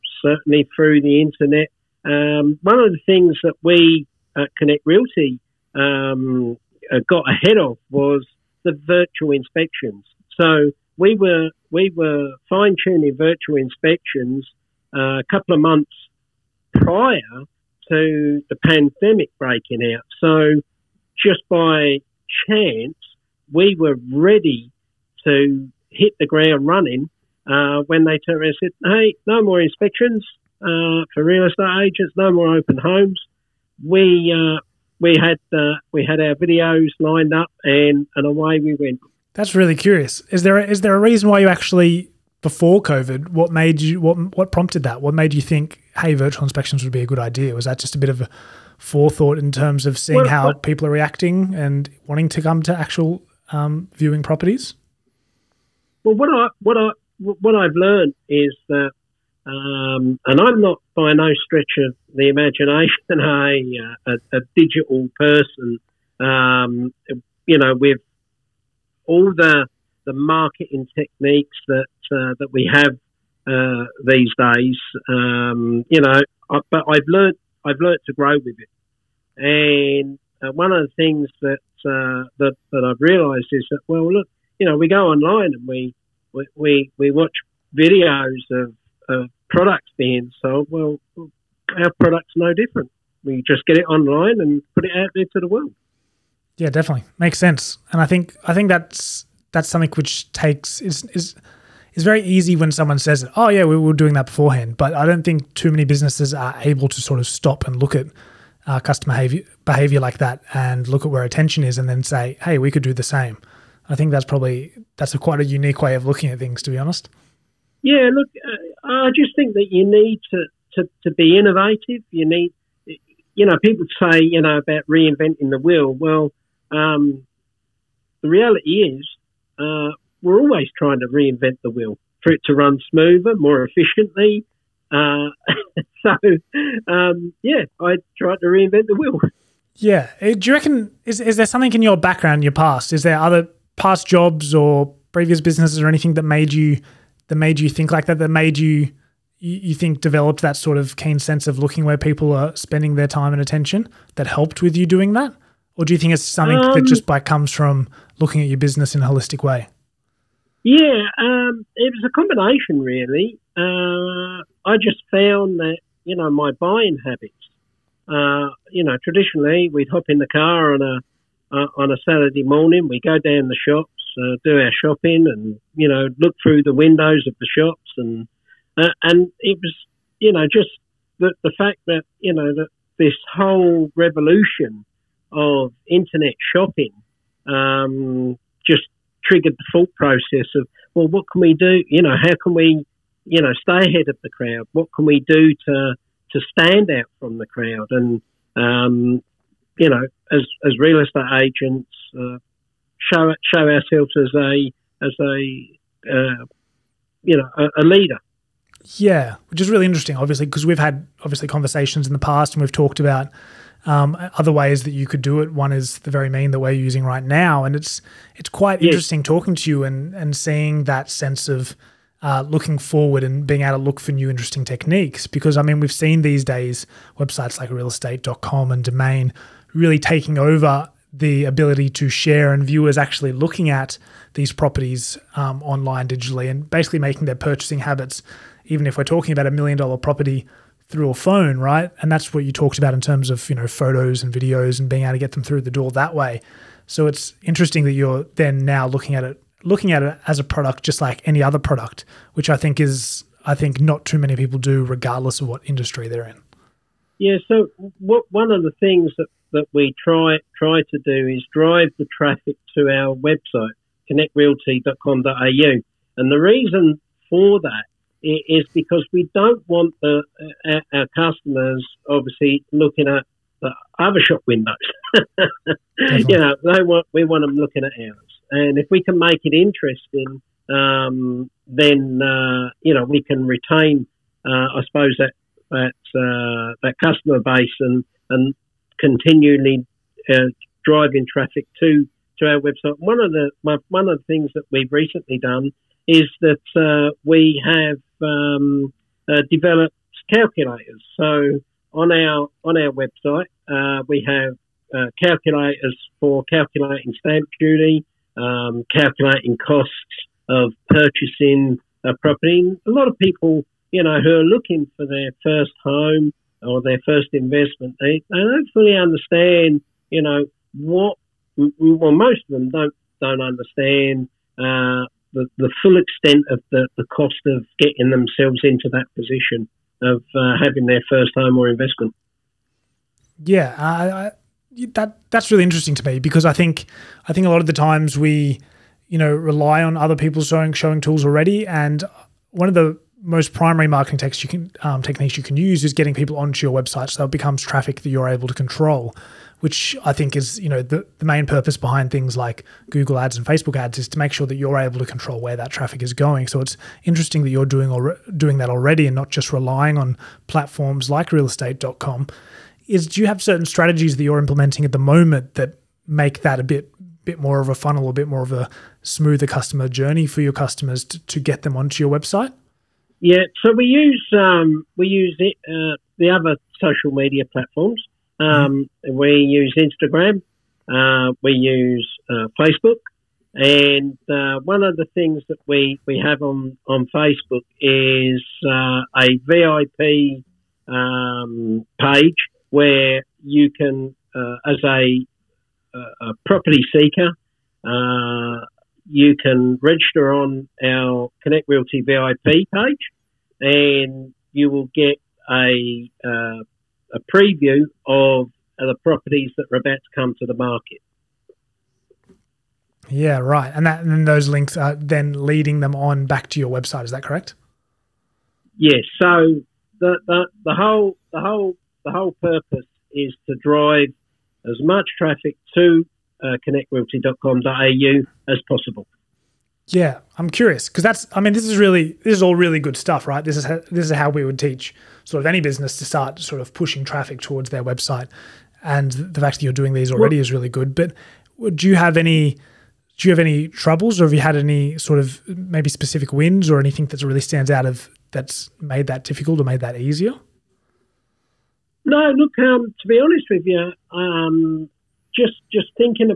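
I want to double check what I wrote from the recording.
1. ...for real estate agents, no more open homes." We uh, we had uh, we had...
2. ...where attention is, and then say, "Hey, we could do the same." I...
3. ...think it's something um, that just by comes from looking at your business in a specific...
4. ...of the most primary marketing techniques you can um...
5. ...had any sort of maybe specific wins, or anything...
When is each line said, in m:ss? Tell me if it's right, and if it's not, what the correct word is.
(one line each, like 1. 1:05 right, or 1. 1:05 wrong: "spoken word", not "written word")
1. 0:31 right
2. 1:51 right
3. 2:35 wrong: "holistic", not "specific"
4. 5:42 right
5. 7:24 right.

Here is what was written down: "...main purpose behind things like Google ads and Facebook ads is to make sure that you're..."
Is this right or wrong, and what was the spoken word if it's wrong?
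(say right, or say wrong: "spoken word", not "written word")
right.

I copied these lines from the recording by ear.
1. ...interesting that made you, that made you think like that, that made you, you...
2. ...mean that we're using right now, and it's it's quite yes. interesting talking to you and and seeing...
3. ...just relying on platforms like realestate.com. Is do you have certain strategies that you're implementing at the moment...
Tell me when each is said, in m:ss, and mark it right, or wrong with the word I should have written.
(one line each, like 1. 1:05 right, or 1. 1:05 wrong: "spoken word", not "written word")
1. 2:25 wrong: "anything", not "interesting"
2. 3:36 right
3. 5:59 right.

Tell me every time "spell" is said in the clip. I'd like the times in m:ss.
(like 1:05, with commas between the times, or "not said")
not said.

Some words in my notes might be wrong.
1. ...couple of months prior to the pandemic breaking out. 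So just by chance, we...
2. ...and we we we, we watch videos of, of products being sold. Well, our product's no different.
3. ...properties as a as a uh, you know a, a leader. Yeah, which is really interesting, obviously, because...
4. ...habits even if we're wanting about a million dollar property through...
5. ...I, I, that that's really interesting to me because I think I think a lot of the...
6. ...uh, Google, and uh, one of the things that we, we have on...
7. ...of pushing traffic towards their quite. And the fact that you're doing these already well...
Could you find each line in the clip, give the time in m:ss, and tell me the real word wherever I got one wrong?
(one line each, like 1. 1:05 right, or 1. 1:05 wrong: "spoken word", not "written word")
1. 0:15 right
2. 1:25 right
3. 3:23 wrong: "ourselves", not "properties"
4. 3:57 wrong: "talking", not "wanting"
5. 5:33 right
6. 6:22 wrong: "Facebook", not "Google"
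7. 7:16 wrong: "website", not "quite".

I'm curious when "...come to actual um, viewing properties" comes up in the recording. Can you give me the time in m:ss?
0:52.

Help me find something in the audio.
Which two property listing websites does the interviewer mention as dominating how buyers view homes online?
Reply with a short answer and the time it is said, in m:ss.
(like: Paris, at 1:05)
realestate.com and Domain, at 3:47.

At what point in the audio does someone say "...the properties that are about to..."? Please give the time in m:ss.
6:48.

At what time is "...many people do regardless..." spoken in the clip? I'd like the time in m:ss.
4:14.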